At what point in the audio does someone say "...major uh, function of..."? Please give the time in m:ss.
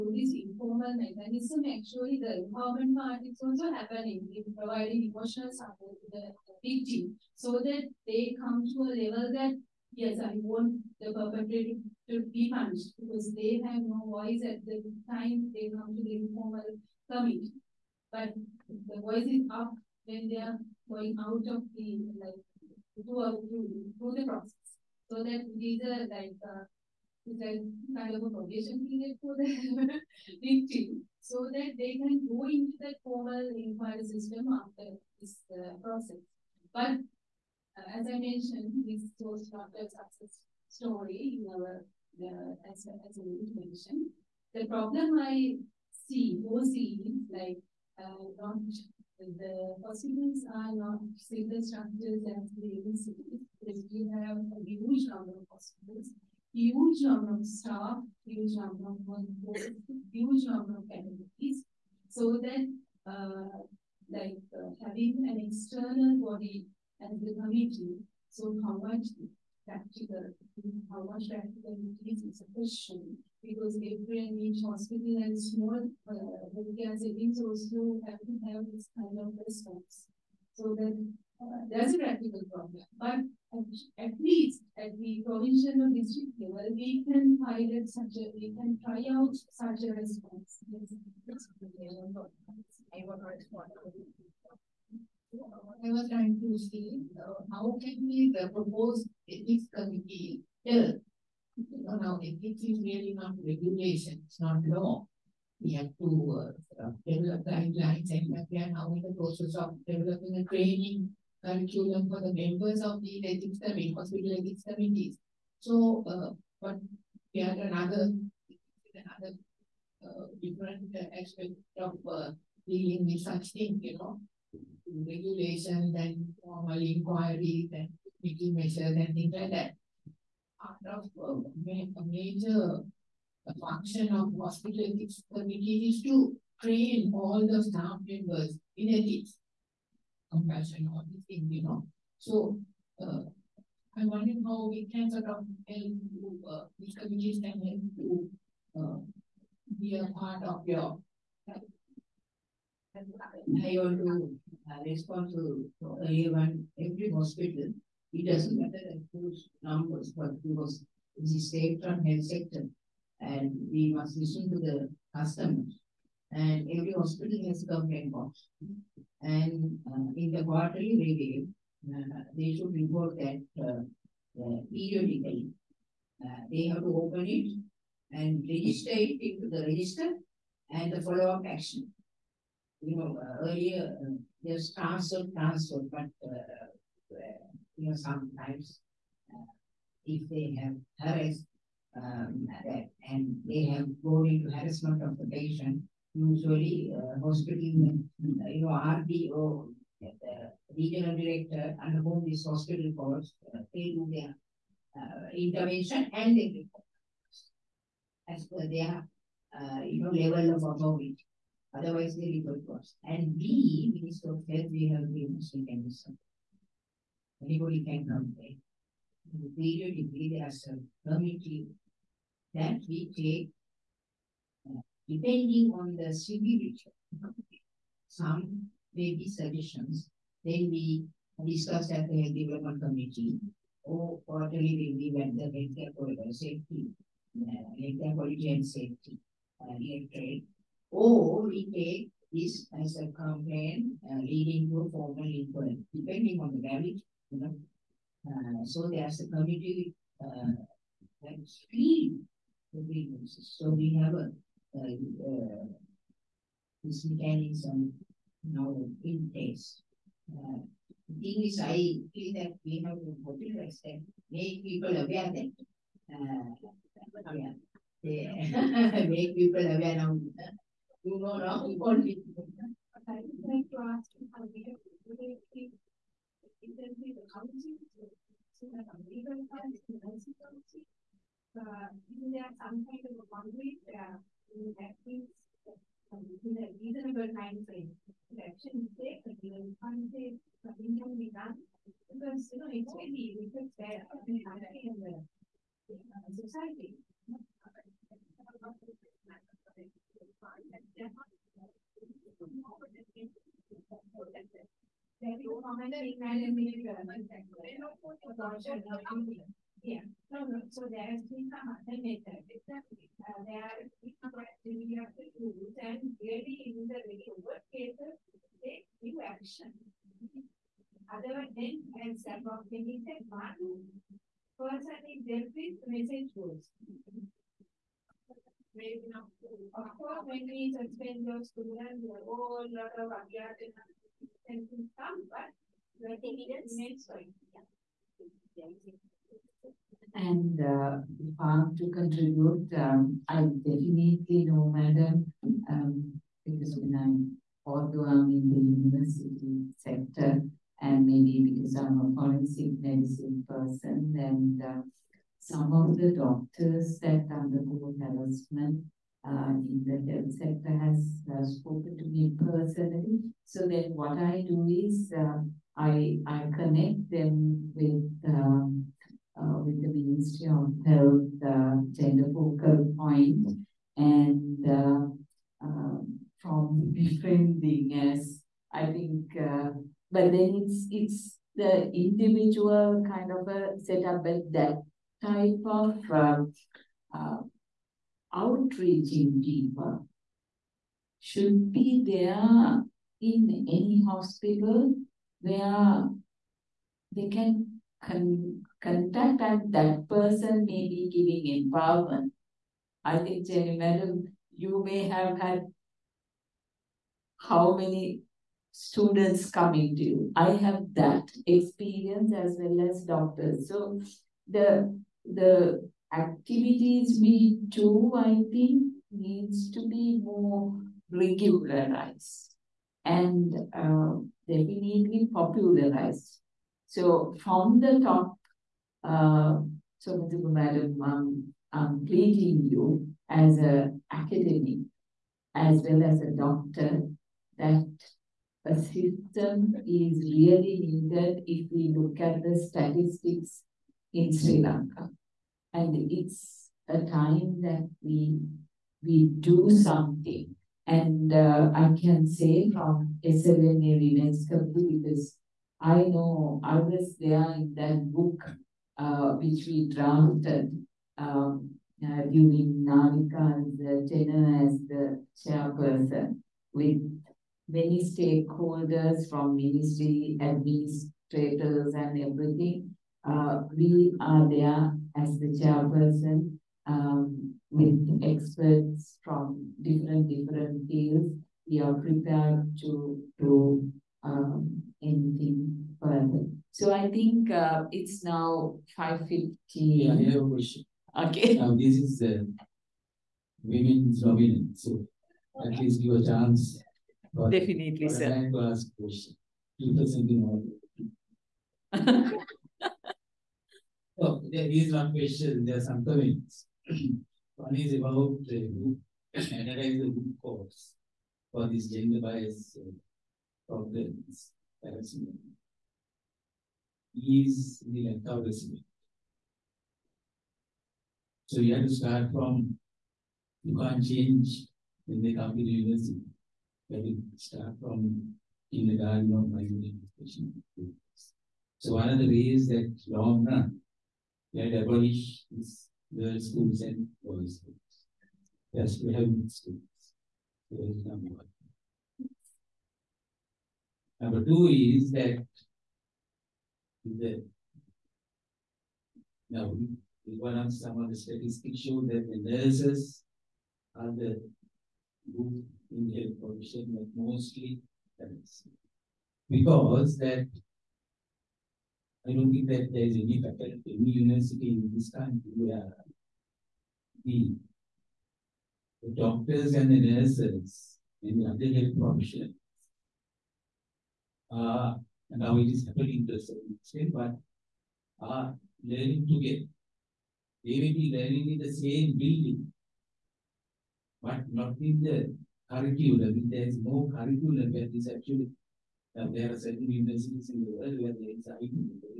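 2:12.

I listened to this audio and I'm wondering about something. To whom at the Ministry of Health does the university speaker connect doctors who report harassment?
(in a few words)
Gender focal point.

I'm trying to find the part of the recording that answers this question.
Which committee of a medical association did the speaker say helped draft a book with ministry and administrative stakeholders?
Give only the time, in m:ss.
7:33.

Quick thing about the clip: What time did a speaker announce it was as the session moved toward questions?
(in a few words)
5.50.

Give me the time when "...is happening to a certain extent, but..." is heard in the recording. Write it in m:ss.
9:35.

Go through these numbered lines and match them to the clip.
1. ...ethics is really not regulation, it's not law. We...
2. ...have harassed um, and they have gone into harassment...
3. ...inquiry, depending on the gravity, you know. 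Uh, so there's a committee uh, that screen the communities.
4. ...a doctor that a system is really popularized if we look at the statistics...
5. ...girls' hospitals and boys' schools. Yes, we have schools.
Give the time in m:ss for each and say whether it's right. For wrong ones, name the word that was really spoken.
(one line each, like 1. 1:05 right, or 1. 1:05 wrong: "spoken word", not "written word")
1. 1:42 right
2. 3:10 right
3. 4:05 wrong: "grievances", not "communities"
4. 7:16 wrong: "needed", not "popularized"
5. 8:56 wrong: "schools", not "hospitals".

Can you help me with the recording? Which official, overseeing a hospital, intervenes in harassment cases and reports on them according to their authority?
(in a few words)
Regional director.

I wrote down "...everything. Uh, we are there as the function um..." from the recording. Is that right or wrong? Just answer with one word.
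wrong.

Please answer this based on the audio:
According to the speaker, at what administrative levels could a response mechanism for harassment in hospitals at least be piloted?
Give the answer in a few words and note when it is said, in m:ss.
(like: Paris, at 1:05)
Provincial or district level, at 1:25.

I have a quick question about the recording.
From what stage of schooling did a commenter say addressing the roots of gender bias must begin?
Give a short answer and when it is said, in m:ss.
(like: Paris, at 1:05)
Kindergarten, at 8:48.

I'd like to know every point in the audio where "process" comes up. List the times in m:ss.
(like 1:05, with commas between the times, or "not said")
0:24, 0:35, 1:49.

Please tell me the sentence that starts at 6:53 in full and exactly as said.
So the the activities we do, I think, needs to be more regularized and uh, definitely popularized.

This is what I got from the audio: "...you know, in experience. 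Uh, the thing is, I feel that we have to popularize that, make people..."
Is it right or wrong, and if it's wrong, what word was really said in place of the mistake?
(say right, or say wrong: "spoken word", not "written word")
wrong: "place", not "experience".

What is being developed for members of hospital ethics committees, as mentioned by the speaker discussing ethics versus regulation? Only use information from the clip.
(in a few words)
Training curriculum.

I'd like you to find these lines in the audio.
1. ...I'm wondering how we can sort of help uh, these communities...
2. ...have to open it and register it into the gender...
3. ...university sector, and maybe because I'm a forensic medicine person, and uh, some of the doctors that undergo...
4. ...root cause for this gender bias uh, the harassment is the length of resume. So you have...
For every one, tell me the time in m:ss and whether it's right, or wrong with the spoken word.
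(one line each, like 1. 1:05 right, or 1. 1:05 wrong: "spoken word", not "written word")
1. 2:23 right
2. 2:56 wrong: "register", not "gender"
3. 5:48 right
4. 8:30 right.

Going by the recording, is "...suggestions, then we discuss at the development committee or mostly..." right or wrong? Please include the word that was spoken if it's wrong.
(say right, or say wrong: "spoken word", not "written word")
wrong: "quarterly", not "mostly".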